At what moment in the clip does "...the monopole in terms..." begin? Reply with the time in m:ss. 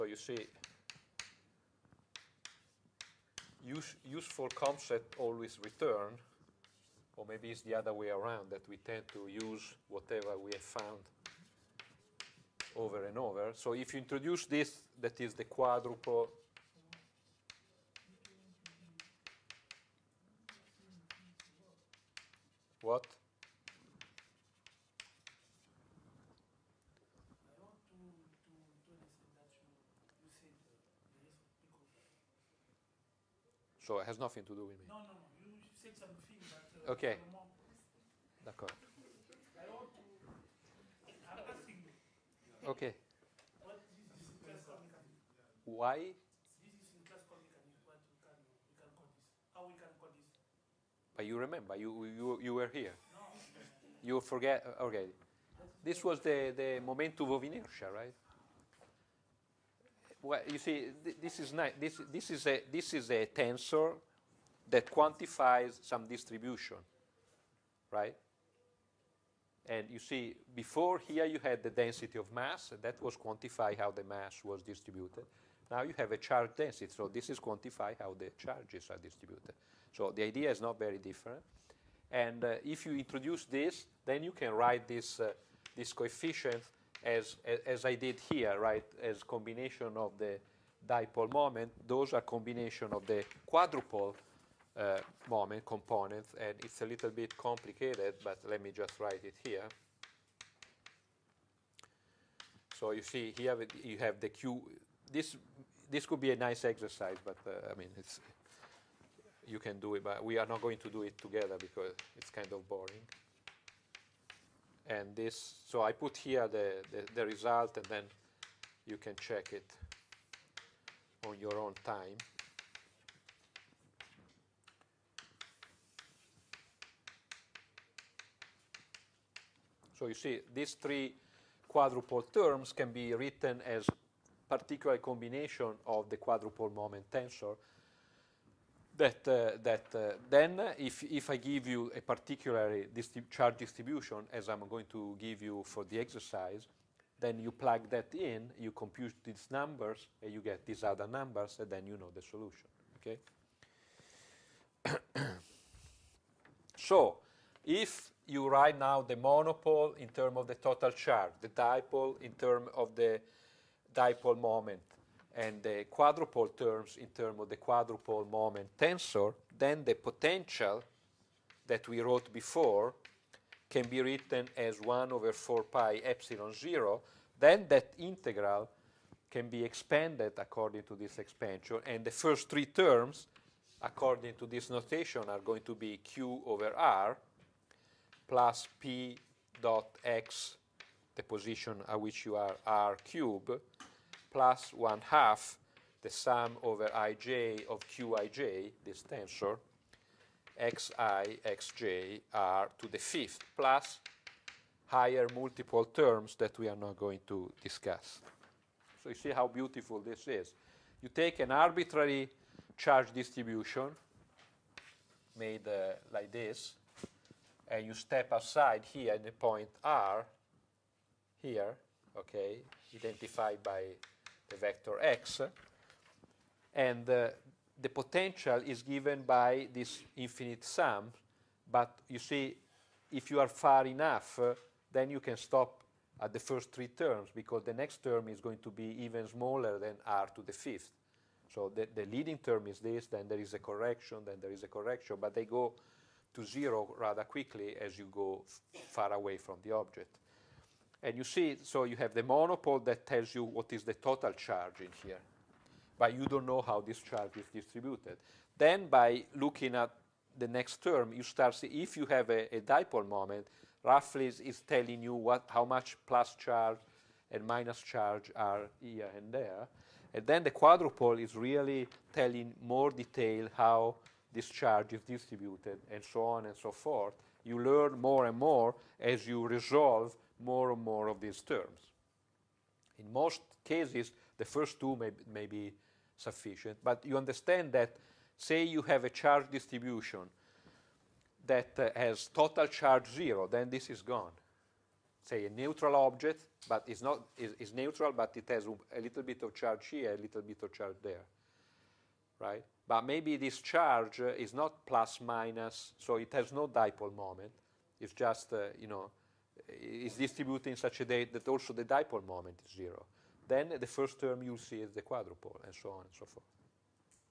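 2:39.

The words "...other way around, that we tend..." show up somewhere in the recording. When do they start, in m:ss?
0:07.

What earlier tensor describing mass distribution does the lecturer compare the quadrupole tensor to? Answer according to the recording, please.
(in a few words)
Momentum of inertia.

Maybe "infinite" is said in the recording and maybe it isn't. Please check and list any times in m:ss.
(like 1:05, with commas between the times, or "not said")
3:50.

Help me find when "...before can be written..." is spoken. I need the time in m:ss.
2:52.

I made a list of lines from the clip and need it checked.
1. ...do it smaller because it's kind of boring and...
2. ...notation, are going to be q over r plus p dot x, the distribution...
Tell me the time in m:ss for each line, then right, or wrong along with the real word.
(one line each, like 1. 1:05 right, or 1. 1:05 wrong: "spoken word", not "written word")
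1. 1:50 wrong: "together", not "smaller"
2. 3:04 wrong: "position", not "distribution".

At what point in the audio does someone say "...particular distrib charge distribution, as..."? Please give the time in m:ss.
2:22.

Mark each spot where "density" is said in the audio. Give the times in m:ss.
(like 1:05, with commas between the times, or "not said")
1:11, 1:16.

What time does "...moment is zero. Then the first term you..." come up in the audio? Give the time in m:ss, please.
5:12.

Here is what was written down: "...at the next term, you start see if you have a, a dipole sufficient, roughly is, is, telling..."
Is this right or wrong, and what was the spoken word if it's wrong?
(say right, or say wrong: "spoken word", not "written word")
wrong: "moment", not "sufficient".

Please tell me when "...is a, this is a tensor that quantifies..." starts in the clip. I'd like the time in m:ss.
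1:02.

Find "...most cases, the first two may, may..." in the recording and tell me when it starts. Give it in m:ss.
4:43.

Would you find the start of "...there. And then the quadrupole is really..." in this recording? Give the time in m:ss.
4:29.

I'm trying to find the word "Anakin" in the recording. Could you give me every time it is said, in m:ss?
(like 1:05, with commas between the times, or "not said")
not said.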